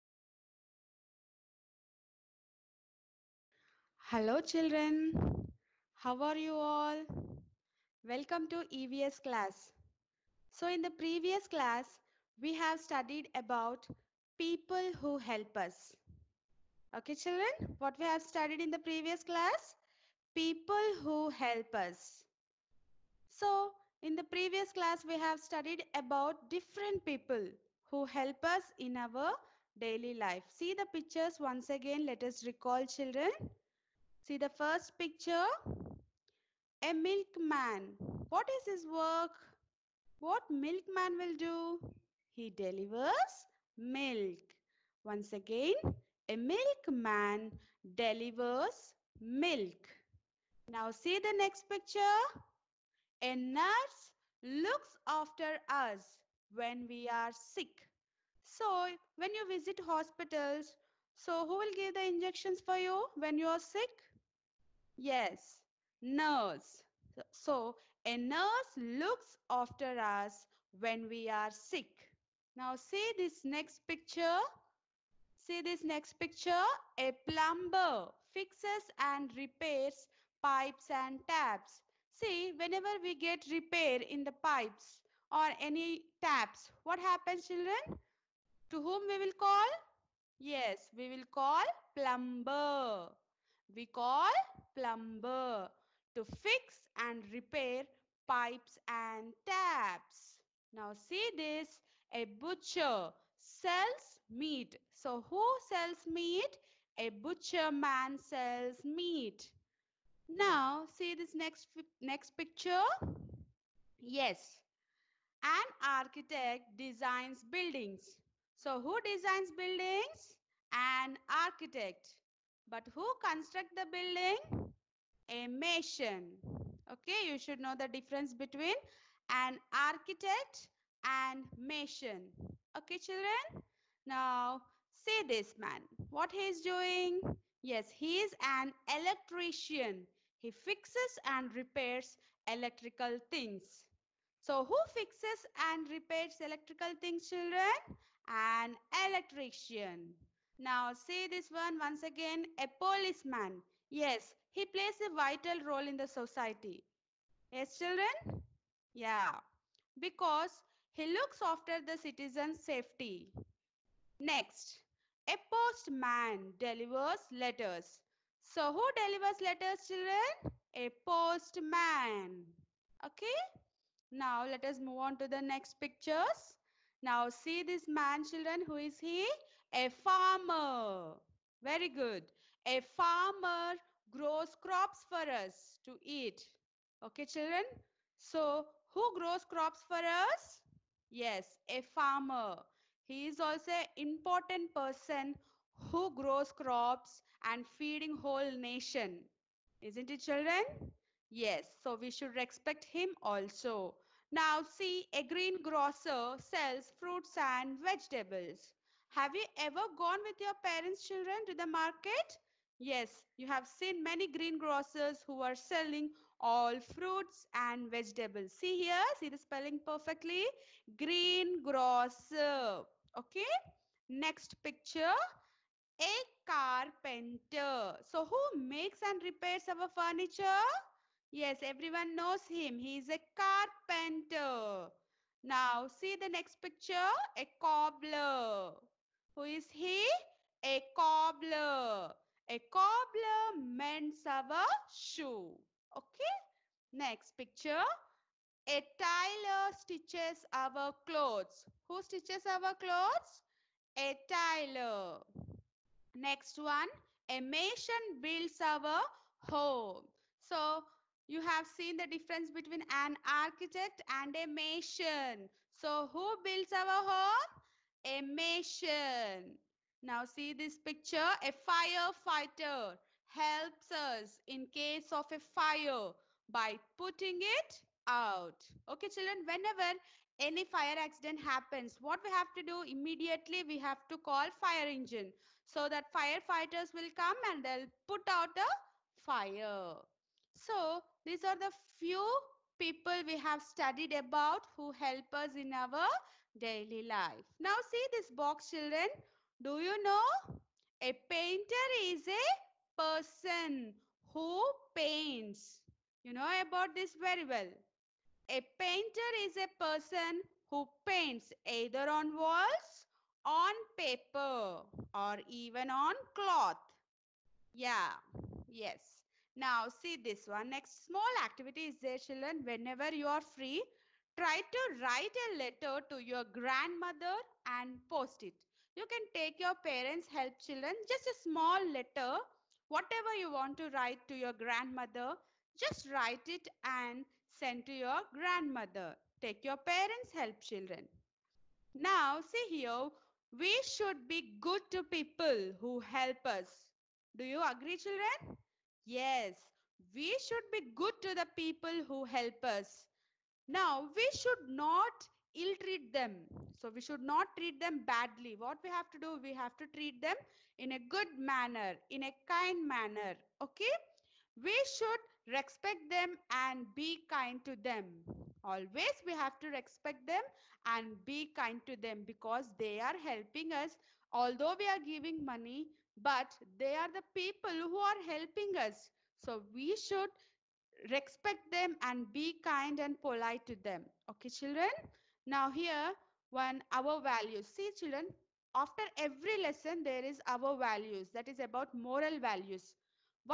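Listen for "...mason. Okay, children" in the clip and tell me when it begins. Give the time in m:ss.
2:11.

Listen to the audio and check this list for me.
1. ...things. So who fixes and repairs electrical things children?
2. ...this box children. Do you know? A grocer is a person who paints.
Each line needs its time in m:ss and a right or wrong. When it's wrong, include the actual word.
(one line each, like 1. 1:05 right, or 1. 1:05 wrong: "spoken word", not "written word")
1. 2:23 right
2. 4:58 wrong: "painter", not "grocer".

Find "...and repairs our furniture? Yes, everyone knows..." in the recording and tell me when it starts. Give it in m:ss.
3:49.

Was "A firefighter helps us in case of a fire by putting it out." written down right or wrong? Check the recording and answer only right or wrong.
right.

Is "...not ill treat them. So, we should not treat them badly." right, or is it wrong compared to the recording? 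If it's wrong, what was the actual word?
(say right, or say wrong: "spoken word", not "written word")
right.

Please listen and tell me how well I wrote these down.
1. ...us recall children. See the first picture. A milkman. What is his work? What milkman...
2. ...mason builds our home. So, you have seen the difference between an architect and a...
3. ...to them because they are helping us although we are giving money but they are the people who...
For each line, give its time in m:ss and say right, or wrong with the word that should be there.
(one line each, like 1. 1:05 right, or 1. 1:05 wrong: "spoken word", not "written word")
1. 0:32 right
2. 4:17 right
3. 6:11 right.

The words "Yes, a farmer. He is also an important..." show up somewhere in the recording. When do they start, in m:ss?
3:11.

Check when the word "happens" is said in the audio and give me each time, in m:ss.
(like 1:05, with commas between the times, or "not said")
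1:26, 4:41.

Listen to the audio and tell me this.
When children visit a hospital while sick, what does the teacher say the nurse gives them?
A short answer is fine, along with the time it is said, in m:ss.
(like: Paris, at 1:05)
injections, at 1:02.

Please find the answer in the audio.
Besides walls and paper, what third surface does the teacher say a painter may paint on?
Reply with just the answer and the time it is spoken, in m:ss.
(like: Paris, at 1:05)
cloth, at 5:16.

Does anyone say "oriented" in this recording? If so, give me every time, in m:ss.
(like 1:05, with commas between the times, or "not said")
not said.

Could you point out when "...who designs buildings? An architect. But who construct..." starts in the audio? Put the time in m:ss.
1:58.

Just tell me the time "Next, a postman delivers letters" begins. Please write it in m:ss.
2:44.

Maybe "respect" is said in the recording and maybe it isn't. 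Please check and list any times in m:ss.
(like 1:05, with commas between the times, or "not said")
3:22, 6:05, 6:09, 6:21.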